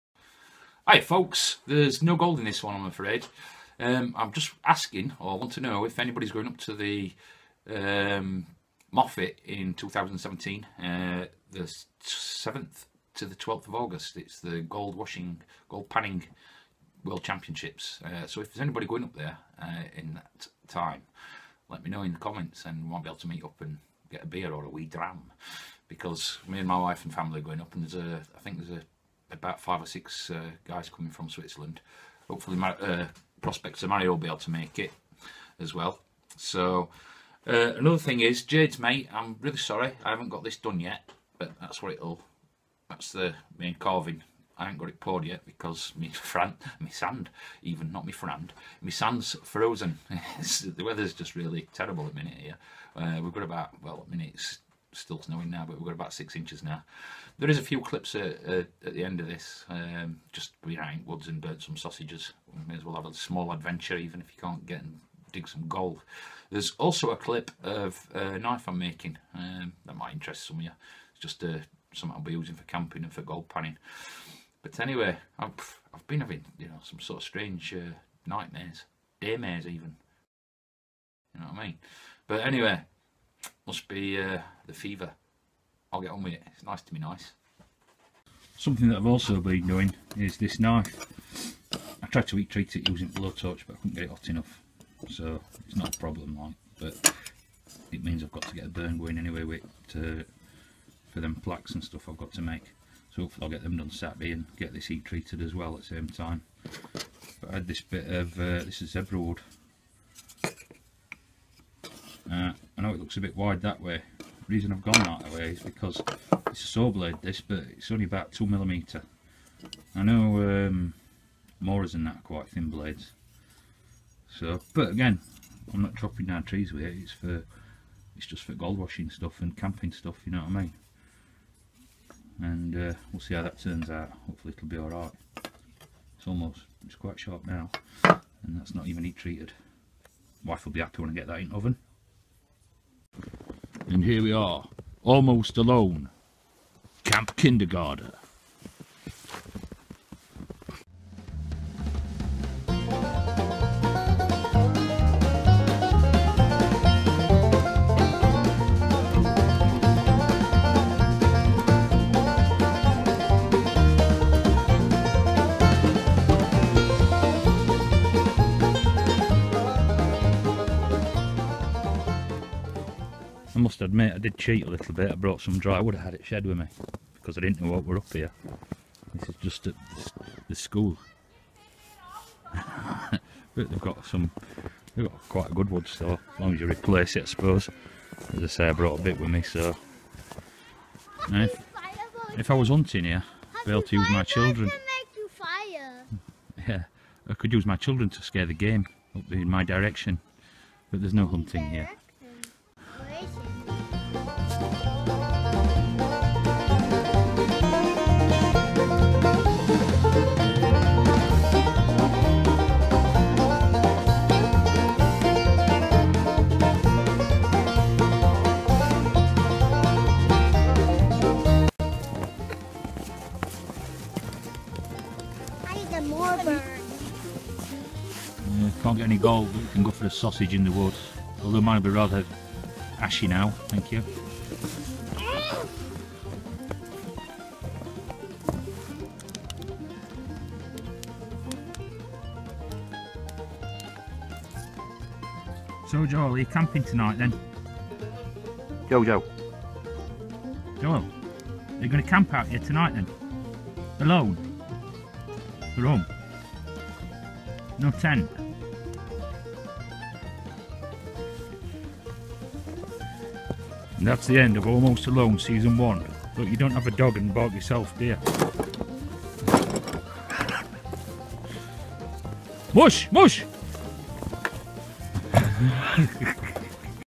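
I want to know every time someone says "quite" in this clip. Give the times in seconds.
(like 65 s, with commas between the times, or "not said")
122 s, 136 s, 185 s.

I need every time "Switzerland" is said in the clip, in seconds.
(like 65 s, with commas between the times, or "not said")
31 s.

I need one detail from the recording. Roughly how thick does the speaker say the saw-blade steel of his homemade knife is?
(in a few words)
2 millimeters.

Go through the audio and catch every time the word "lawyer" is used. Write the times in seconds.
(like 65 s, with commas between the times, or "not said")
not said.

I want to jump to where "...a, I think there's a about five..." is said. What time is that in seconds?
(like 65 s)
28 s.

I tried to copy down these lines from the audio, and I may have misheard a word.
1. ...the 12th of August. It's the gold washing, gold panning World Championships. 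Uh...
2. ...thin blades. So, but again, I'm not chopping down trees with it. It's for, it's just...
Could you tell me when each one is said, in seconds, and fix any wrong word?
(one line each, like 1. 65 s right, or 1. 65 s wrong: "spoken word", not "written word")
1. 13 s right
2. 122 s right.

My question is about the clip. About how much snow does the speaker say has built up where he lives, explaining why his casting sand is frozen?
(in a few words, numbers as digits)
6 inches.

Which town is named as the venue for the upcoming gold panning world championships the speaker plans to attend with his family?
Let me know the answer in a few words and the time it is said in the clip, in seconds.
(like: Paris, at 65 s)
Moffat, at 8 s.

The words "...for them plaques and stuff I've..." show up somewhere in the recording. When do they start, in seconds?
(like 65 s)
101 s.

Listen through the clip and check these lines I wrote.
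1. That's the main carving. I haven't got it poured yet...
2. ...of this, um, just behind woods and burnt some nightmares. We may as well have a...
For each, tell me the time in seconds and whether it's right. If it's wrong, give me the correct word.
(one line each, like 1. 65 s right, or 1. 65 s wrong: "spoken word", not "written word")
1. 42 s right
2. 59 s wrong: "sausages", not "nightmares".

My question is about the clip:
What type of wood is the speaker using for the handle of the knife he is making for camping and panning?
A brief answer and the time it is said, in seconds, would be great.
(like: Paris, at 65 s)
zebra wood, at 108 s.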